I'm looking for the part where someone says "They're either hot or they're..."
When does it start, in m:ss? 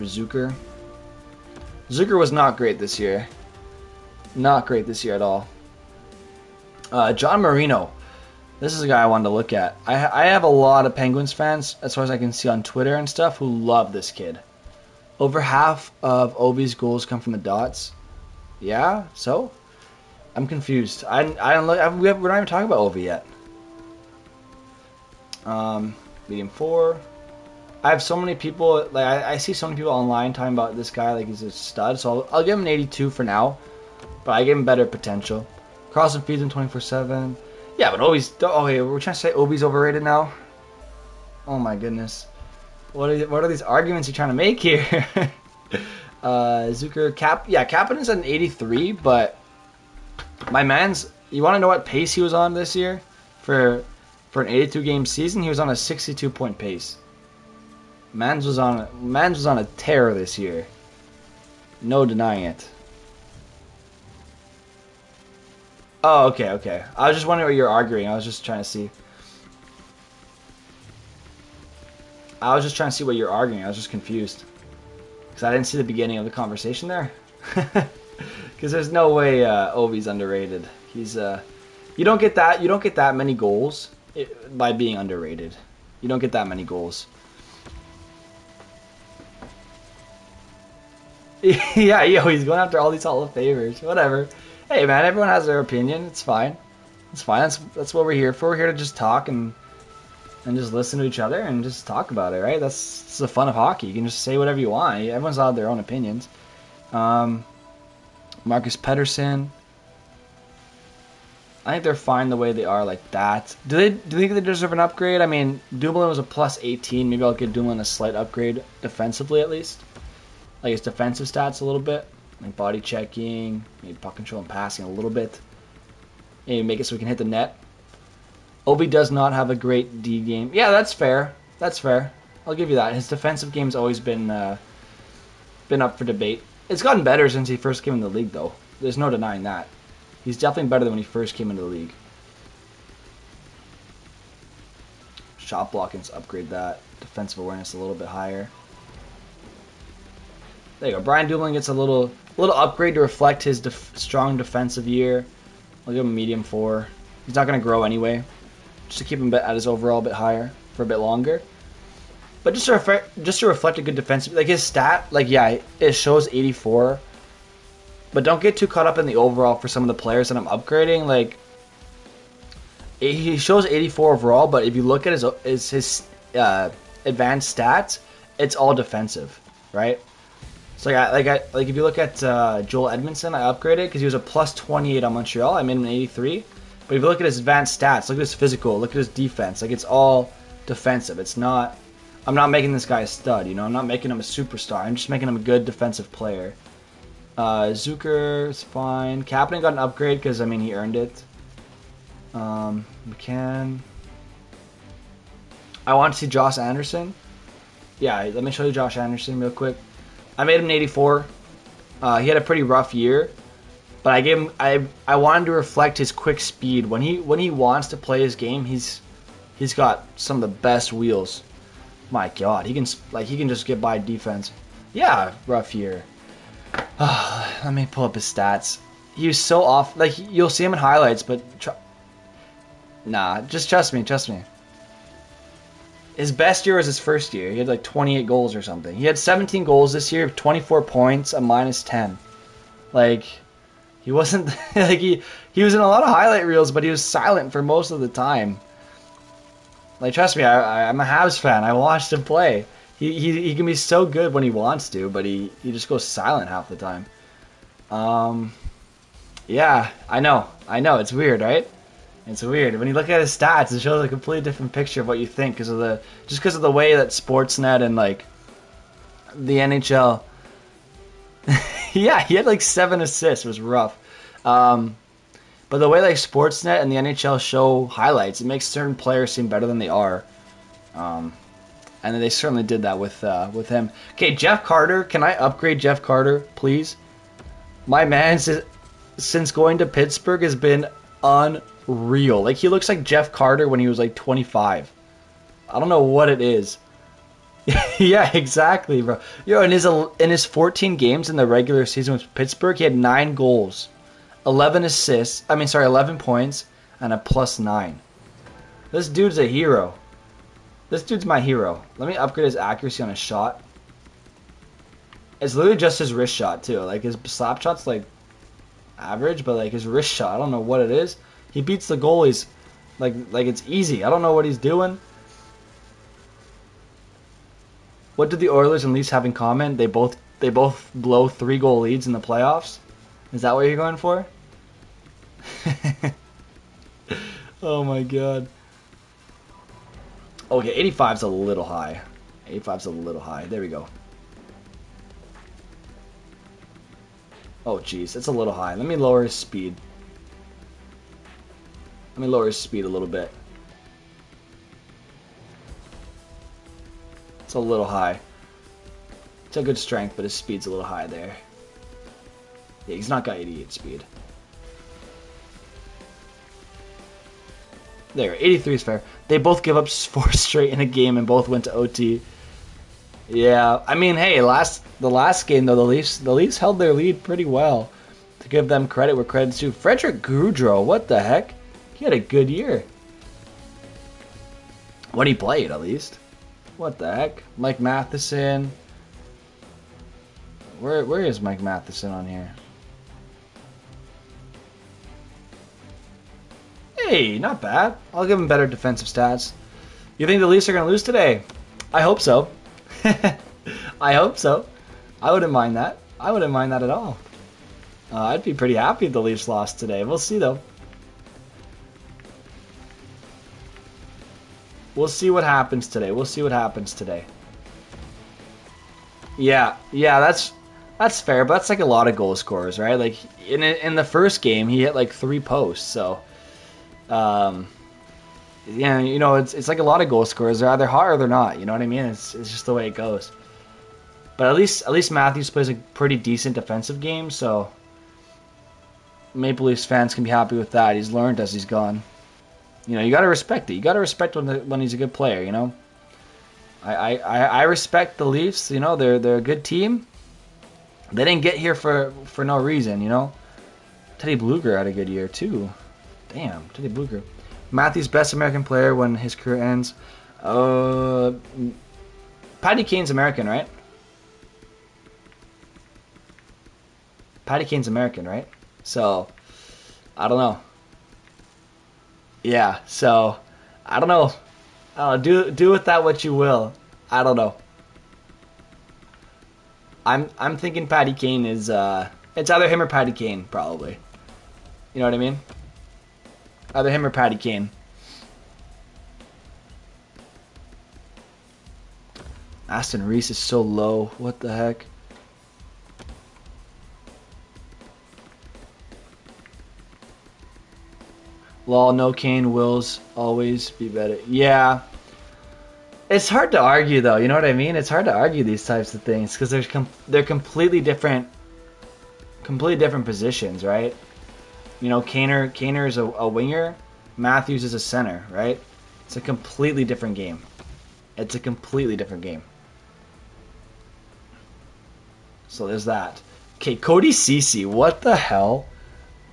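7:10.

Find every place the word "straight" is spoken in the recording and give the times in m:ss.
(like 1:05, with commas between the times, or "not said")
6:10.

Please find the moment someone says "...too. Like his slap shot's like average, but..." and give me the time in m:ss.
5:16.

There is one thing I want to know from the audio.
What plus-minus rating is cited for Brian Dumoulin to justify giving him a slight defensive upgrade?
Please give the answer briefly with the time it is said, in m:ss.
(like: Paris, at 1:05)
plus 18, at 1:56.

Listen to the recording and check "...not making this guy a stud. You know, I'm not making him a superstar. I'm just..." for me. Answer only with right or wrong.
right.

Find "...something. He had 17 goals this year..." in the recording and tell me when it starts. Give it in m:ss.
3:58.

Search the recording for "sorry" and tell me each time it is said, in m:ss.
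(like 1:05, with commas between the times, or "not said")
5:05.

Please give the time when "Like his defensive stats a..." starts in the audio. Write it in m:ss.
2:00.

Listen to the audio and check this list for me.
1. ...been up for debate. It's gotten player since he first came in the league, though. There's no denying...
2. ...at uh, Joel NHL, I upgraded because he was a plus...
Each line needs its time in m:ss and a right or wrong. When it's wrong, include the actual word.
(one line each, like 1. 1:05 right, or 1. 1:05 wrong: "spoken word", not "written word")
1. 2:15 wrong: "better", not "player"
2. 3:01 wrong: "Edmundson", not "NHL".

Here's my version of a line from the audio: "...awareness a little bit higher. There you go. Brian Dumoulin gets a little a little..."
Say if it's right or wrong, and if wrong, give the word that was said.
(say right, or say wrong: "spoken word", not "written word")
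right.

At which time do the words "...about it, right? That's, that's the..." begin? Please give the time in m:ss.
1:42.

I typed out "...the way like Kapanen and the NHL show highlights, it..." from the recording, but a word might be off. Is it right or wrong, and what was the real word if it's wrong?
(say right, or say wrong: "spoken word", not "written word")
wrong: "Sportsnet", not "Kapanen".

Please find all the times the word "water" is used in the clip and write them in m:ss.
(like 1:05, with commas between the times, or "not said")
not said.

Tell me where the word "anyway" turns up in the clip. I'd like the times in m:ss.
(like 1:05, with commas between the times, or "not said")
2:37.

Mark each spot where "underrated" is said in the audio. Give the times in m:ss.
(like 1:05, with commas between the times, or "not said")
1:20, 1:24.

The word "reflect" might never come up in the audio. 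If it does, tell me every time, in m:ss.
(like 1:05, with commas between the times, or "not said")
2:33, 2:43, 3:35.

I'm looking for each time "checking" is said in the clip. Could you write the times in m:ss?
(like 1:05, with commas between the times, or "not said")
2:02.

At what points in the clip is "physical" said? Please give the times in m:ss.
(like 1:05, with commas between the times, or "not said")
3:08.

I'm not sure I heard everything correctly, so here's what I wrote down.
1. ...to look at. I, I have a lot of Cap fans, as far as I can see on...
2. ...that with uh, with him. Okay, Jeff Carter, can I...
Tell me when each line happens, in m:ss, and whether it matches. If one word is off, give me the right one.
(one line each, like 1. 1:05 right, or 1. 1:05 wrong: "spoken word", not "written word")
1. 0:09 wrong: "Penguins", not "Cap"
2. 4:42 right.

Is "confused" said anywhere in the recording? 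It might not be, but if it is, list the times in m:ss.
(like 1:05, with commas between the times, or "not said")
0:20, 1:13.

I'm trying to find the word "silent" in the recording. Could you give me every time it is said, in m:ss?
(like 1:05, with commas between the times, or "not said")
4:07, 4:16.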